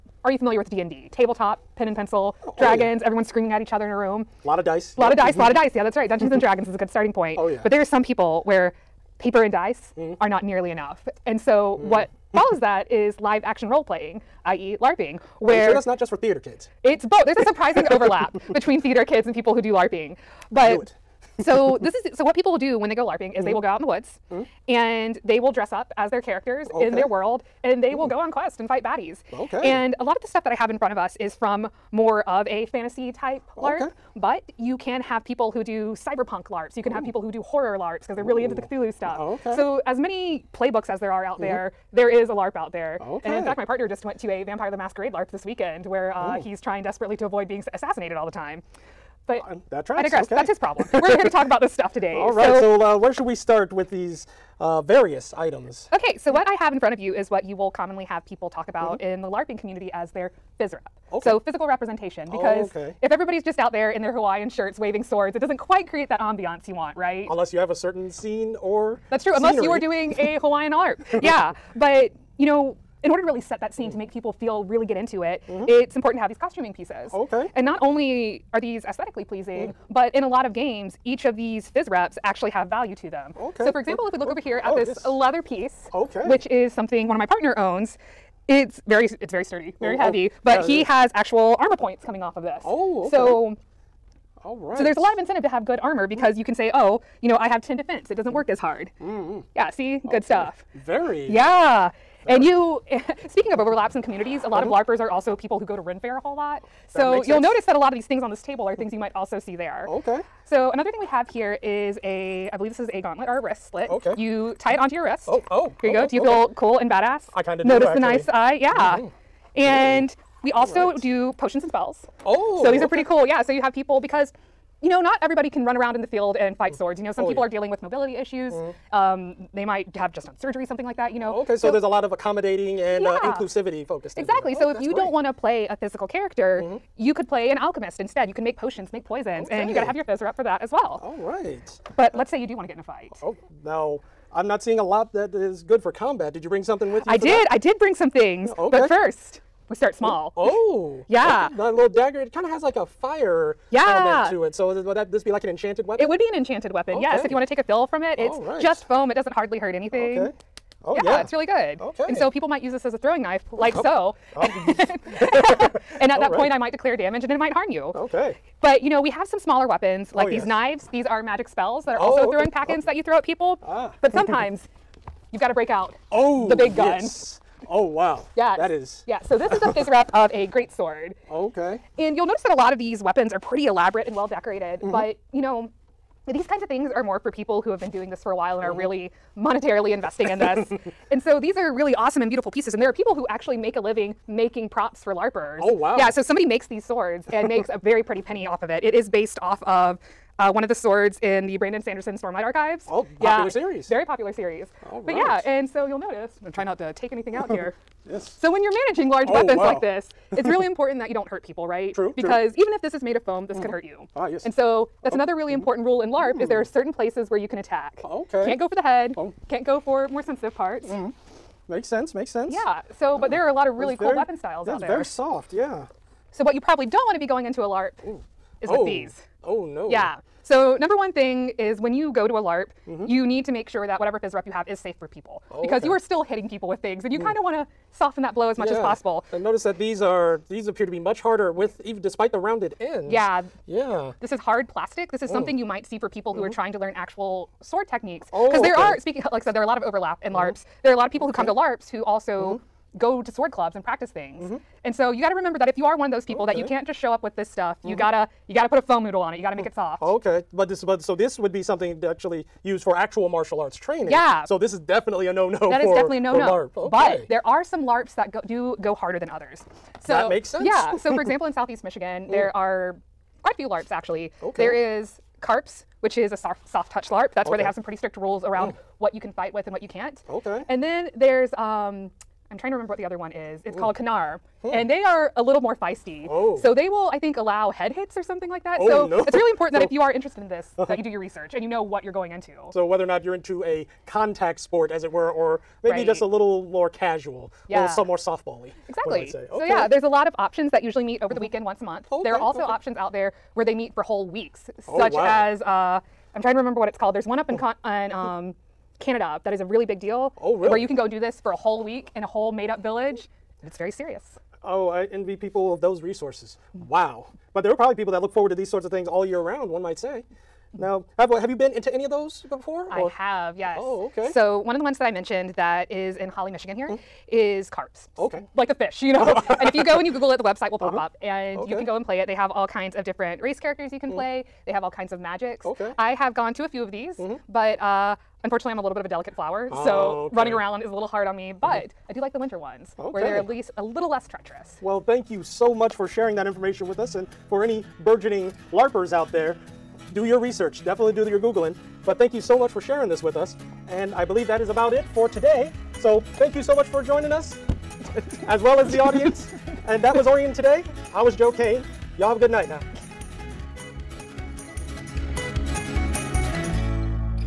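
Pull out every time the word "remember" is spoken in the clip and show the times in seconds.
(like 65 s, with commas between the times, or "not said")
255 s, 282 s, 306 s.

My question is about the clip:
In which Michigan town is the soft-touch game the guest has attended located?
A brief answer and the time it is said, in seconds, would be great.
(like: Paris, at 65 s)
Holly, Michigan, at 326 s.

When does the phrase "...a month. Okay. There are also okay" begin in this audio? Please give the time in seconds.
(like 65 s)
301 s.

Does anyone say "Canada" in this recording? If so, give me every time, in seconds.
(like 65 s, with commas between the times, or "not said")
309 s.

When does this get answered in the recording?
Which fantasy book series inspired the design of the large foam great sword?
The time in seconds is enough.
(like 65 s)
202 s.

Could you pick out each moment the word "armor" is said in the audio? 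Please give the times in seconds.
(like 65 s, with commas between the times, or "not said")
91 s, 95 s.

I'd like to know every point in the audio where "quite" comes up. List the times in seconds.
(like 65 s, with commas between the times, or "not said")
65 s, 273 s.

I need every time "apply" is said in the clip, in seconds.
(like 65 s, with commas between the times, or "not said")
not said.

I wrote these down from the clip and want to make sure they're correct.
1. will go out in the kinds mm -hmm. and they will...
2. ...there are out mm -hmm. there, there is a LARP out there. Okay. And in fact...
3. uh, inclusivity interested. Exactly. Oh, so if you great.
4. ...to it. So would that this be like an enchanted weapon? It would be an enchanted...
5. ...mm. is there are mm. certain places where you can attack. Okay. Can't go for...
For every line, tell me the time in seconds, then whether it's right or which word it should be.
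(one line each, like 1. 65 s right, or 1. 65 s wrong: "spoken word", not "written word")
1. 23 s wrong: "woods", not "kinds"
2. 40 s right
3. 133 s wrong: "focused", not "interested"
4. 154 s right
5. 216 s right.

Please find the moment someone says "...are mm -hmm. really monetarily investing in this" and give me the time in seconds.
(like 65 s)
188 s.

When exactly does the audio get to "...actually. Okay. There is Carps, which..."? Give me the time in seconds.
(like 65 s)
273 s.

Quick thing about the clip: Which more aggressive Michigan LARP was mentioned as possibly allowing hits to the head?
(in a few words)
Kanar.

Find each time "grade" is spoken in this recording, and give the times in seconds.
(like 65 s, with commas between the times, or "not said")
not said.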